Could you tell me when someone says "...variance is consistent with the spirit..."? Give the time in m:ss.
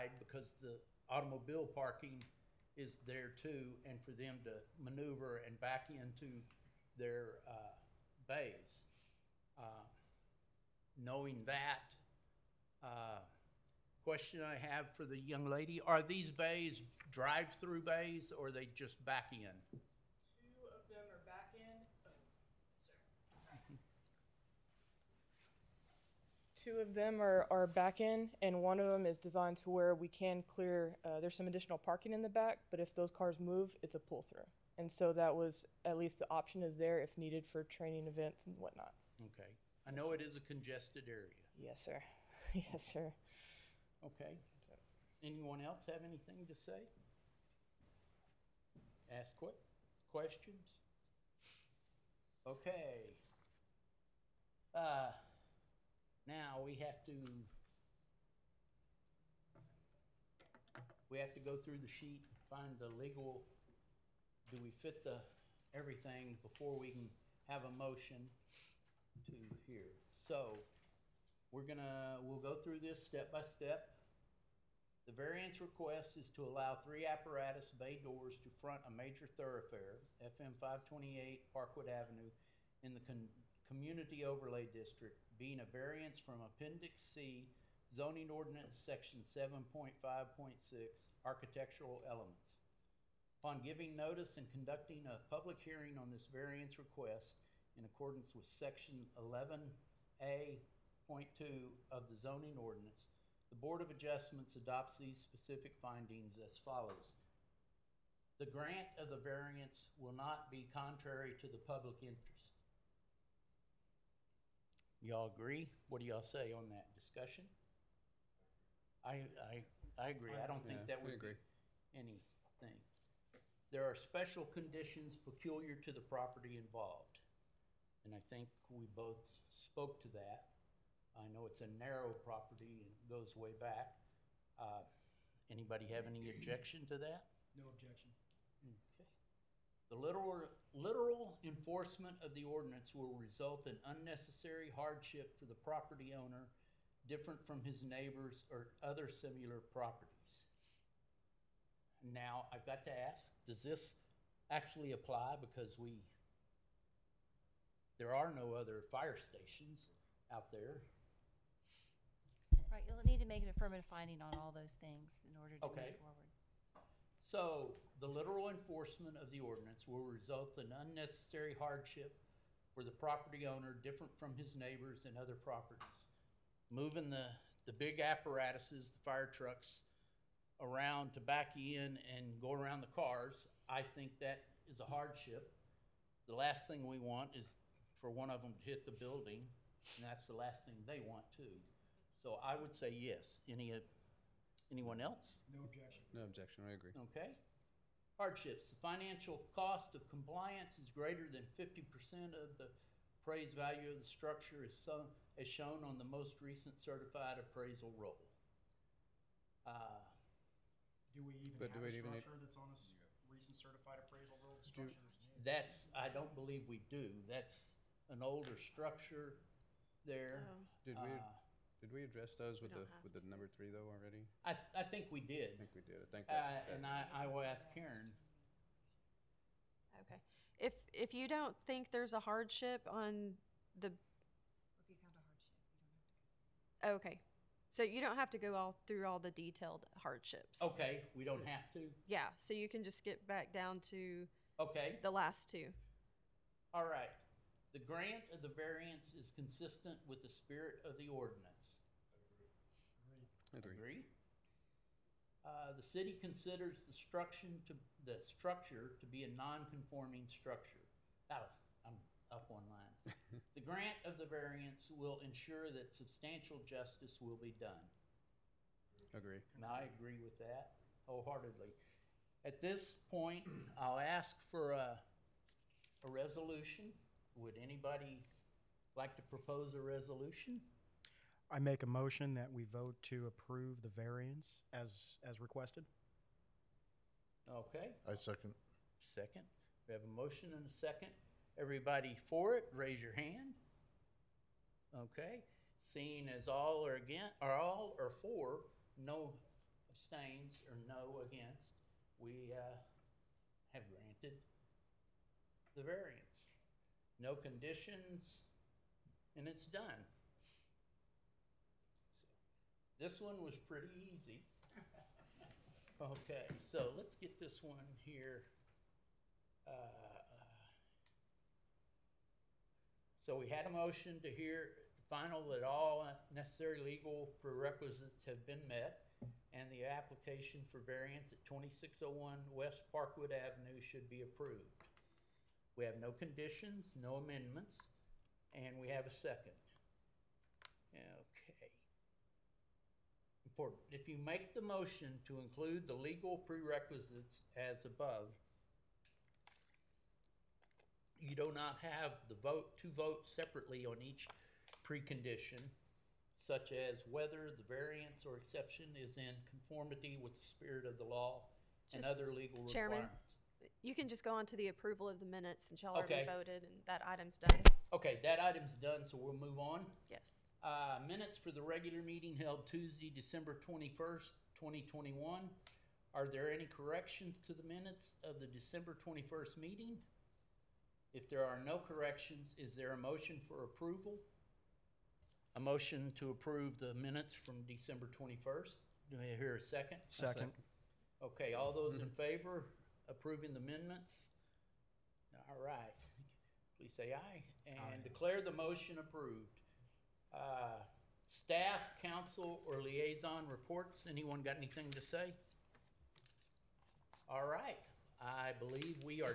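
4:08.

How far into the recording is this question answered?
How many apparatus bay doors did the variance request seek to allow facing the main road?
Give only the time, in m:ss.
1:16.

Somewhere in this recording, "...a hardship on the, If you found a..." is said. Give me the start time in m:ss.
3:52.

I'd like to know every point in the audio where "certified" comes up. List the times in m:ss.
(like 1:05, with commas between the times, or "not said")
3:26, 3:33.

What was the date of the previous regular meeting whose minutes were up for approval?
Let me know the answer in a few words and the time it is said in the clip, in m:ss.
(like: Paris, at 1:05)
December 21st, 2021, at 6:13.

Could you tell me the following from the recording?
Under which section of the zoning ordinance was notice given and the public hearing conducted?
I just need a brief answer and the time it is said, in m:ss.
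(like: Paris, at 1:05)
11A.2, at 1:38.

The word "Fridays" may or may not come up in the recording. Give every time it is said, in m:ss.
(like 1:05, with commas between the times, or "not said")
not said.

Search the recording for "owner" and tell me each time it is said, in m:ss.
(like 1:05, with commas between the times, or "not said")
2:26, 2:53.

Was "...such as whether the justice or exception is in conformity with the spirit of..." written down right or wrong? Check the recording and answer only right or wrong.
wrong.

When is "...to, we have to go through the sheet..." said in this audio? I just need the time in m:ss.
0:57.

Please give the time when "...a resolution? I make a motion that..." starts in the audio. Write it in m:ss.
4:39.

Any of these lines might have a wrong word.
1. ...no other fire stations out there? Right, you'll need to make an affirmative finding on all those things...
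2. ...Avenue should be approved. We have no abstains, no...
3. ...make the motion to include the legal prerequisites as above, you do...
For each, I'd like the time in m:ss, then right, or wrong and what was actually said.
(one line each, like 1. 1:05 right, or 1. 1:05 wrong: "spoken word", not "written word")
1. 2:38 right
2. 5:33 wrong: "conditions", not "abstains"
3. 5:44 right.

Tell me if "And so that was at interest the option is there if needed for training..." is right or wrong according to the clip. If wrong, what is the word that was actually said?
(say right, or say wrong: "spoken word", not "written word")
wrong: "least", not "interest".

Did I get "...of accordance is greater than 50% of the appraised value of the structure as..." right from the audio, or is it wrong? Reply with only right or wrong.
wrong.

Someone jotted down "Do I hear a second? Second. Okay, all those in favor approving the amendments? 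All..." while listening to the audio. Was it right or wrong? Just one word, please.
right.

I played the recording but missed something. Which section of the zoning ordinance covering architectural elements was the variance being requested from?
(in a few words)
7.5.6.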